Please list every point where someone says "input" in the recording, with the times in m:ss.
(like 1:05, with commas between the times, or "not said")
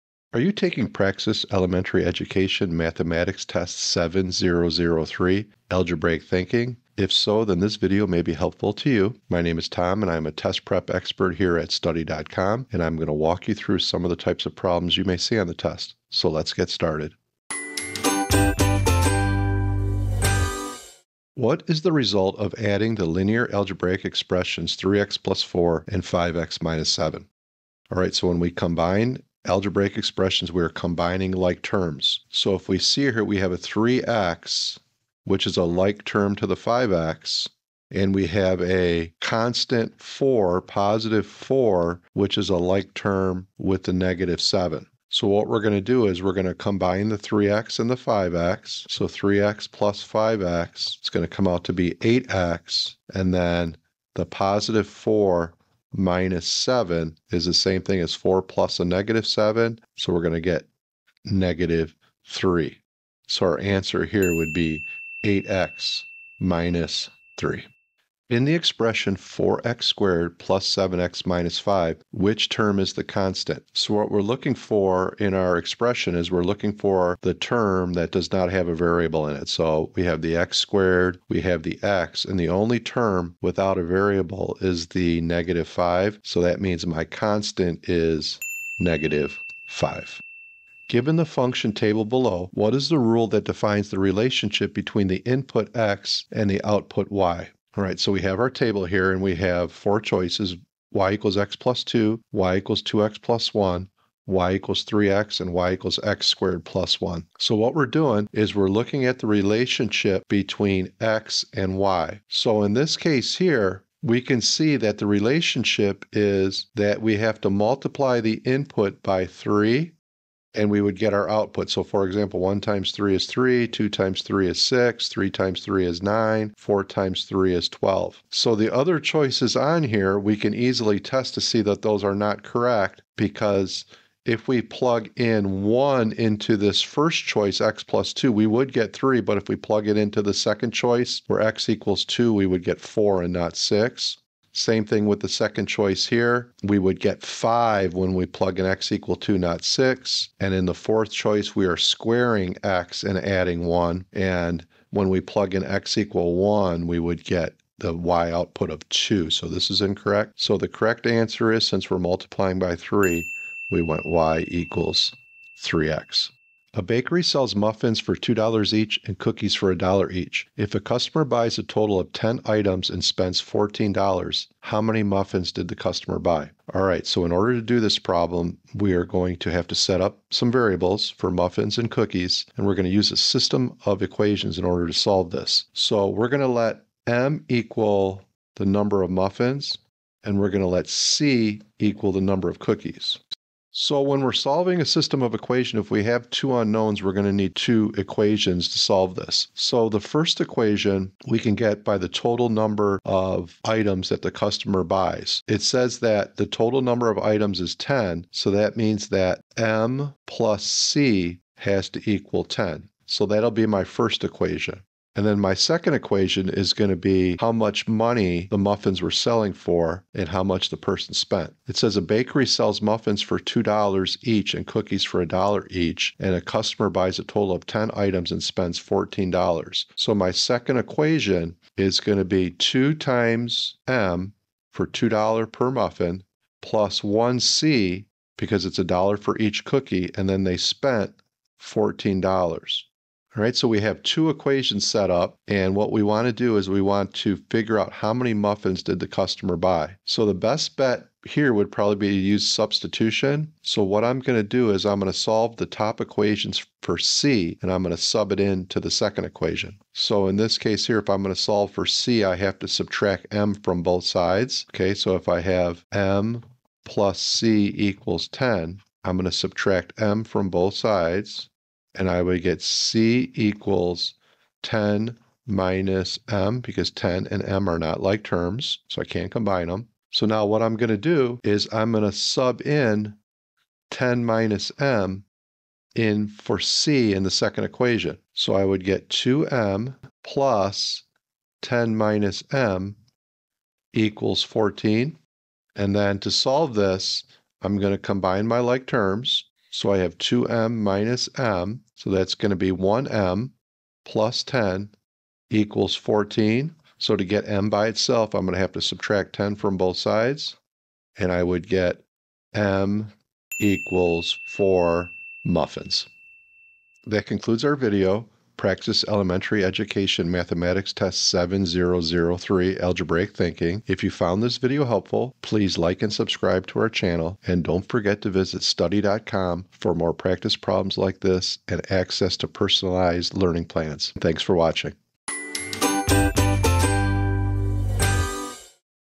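1:35, 1:58.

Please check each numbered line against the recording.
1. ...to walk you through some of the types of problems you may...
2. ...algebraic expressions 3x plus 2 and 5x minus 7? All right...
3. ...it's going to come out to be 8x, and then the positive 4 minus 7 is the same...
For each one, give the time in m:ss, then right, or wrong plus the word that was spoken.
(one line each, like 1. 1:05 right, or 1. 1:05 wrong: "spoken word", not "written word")
1. 0:13 right
2. 0:23 wrong: "4", not "2"
3. 0:50 right.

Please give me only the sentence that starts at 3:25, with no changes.
It says that the total number of items is 10, so that means that M plus C has to equal 10.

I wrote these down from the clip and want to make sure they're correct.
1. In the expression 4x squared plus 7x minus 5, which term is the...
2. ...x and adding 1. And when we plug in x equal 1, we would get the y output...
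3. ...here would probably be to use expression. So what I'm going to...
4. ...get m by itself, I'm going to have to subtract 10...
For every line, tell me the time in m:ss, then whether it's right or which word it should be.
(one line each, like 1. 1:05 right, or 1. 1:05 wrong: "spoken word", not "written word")
1. 1:08 right
2. 2:32 right
3. 4:11 wrong: "substitution", not "expression"
4. 5:07 right.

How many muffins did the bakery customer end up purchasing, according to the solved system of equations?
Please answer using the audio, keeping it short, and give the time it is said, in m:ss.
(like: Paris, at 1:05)
4, at 5:14.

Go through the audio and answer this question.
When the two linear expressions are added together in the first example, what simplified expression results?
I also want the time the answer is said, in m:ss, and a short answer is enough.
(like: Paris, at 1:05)
8x - 3, at 1:05.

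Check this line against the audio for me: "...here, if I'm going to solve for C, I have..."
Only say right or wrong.
right.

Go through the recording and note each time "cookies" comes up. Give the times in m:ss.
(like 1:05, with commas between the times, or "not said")
2:49, 3:01, 3:12, 3:44, 3:59.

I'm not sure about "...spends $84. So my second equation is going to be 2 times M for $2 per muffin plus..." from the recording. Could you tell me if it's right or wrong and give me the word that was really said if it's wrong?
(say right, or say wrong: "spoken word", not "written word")
wrong: "14", not "84".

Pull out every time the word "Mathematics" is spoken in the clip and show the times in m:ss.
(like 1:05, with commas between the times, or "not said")
0:02, 5:20.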